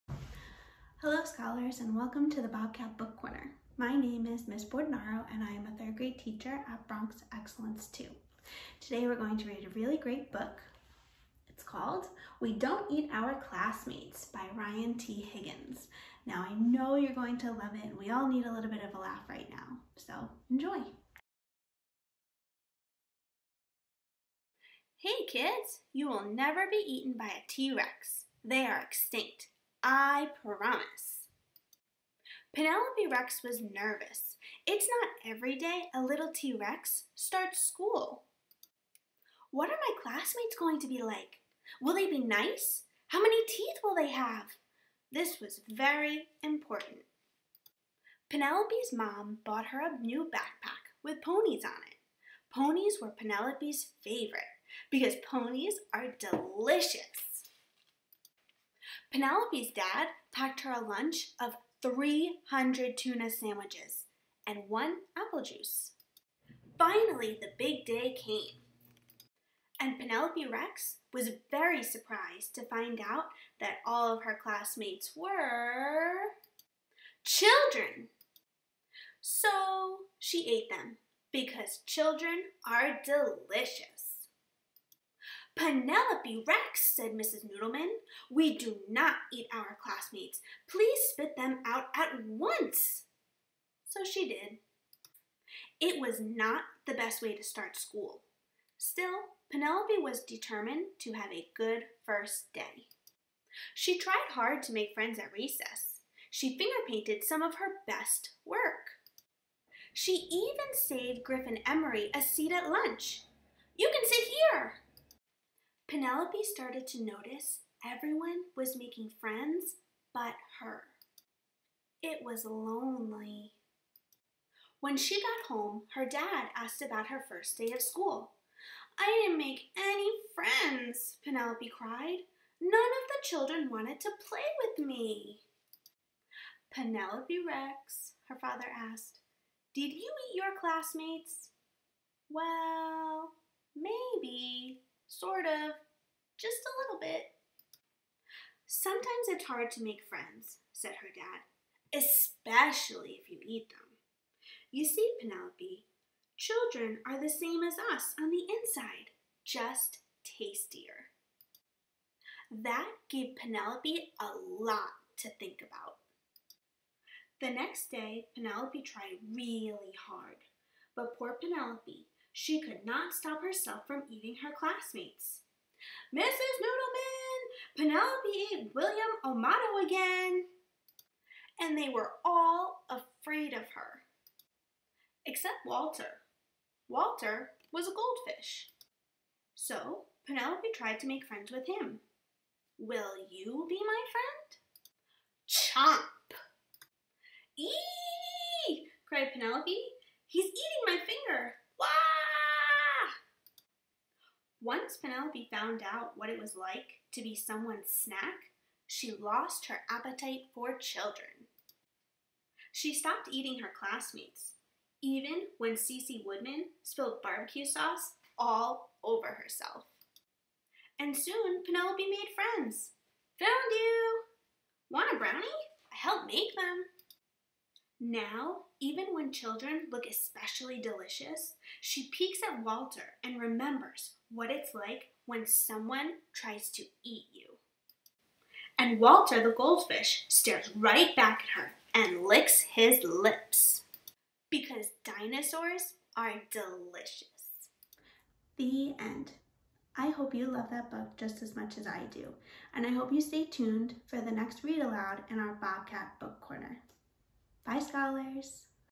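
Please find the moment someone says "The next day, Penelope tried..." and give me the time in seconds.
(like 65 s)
167 s.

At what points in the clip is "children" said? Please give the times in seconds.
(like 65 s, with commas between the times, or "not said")
77 s, 81 s, 133 s, 156 s, 210 s, 229 s.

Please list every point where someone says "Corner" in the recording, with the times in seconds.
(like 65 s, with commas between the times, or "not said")
3 s, 256 s.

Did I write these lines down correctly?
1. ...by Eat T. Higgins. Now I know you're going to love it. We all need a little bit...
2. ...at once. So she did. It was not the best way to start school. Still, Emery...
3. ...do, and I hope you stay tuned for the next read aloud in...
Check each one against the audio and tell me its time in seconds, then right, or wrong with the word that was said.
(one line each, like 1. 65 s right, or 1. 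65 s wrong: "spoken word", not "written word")
1. 14 s wrong: "Ryan", not "Eat"
2. 91 s wrong: "Penelope", not "Emery"
3. 252 s right.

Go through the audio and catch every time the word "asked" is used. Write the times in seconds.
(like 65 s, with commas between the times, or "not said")
126 s, 138 s.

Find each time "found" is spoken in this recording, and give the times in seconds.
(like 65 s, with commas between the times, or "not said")
205 s, 223 s.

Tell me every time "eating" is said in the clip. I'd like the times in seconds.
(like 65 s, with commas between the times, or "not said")
174 s, 213 s.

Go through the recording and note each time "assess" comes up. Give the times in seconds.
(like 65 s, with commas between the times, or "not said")
not said.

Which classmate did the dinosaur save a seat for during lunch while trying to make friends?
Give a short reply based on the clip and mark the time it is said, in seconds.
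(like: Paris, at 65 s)
Griffin Emery, at 111 s.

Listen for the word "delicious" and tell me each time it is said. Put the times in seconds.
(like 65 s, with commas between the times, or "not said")
56 s, 83 s, 230 s, 246 s.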